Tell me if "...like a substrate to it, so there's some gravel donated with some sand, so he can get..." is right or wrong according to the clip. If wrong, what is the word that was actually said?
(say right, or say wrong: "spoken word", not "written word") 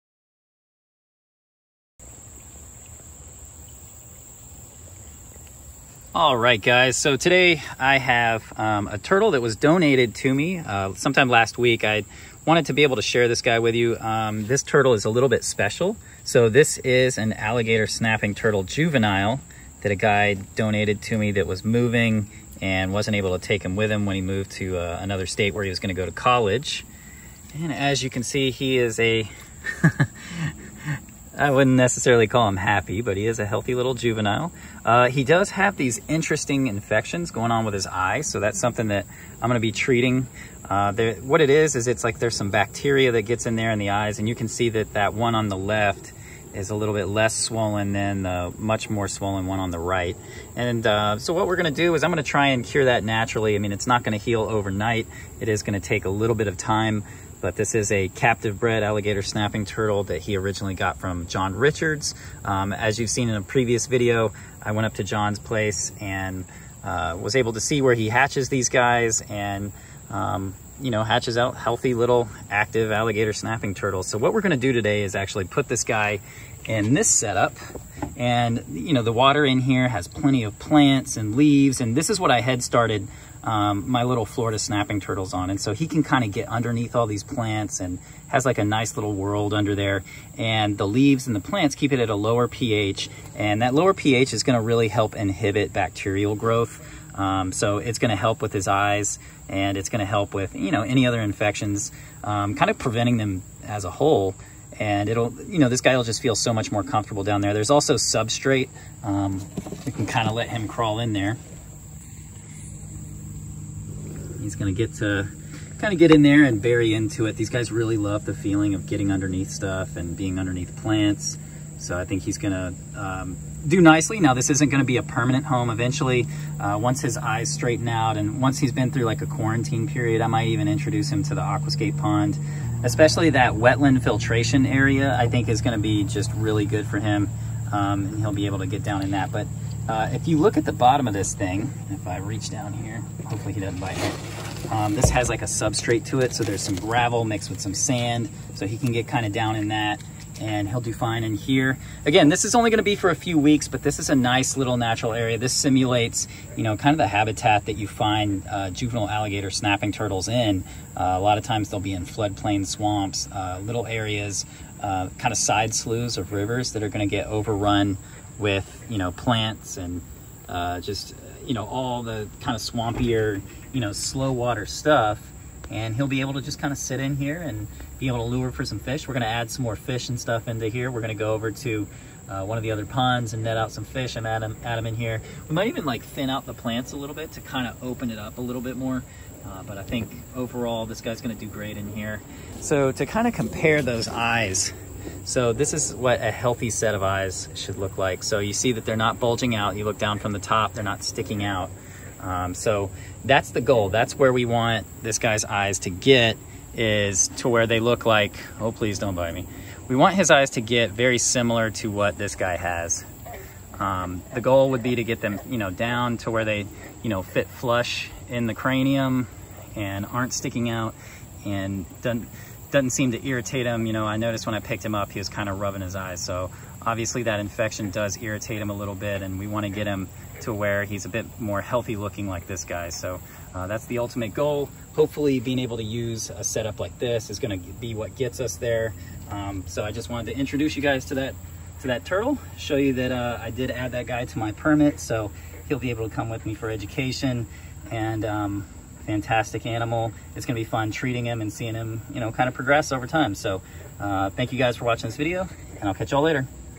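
wrong: "mixed", not "donated".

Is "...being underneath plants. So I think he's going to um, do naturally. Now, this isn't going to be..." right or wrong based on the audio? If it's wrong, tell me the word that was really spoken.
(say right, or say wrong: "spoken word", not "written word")
wrong: "nicely", not "naturally".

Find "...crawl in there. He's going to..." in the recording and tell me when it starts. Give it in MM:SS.
01:50.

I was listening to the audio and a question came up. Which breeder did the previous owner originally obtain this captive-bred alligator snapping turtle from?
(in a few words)
John Richards.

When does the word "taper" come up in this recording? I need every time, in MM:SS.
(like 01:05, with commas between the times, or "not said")
not said.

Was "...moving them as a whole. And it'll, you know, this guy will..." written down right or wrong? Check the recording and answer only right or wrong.
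wrong.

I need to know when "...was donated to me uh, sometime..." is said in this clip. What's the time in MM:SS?
00:09.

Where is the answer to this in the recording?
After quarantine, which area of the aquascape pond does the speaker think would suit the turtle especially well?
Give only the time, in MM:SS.
02:13.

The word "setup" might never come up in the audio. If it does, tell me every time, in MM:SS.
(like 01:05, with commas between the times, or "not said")
01:17, 03:56.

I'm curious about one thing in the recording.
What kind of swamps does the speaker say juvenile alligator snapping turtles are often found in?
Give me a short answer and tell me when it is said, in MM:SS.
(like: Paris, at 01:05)
Floodplain swamps, at 02:42.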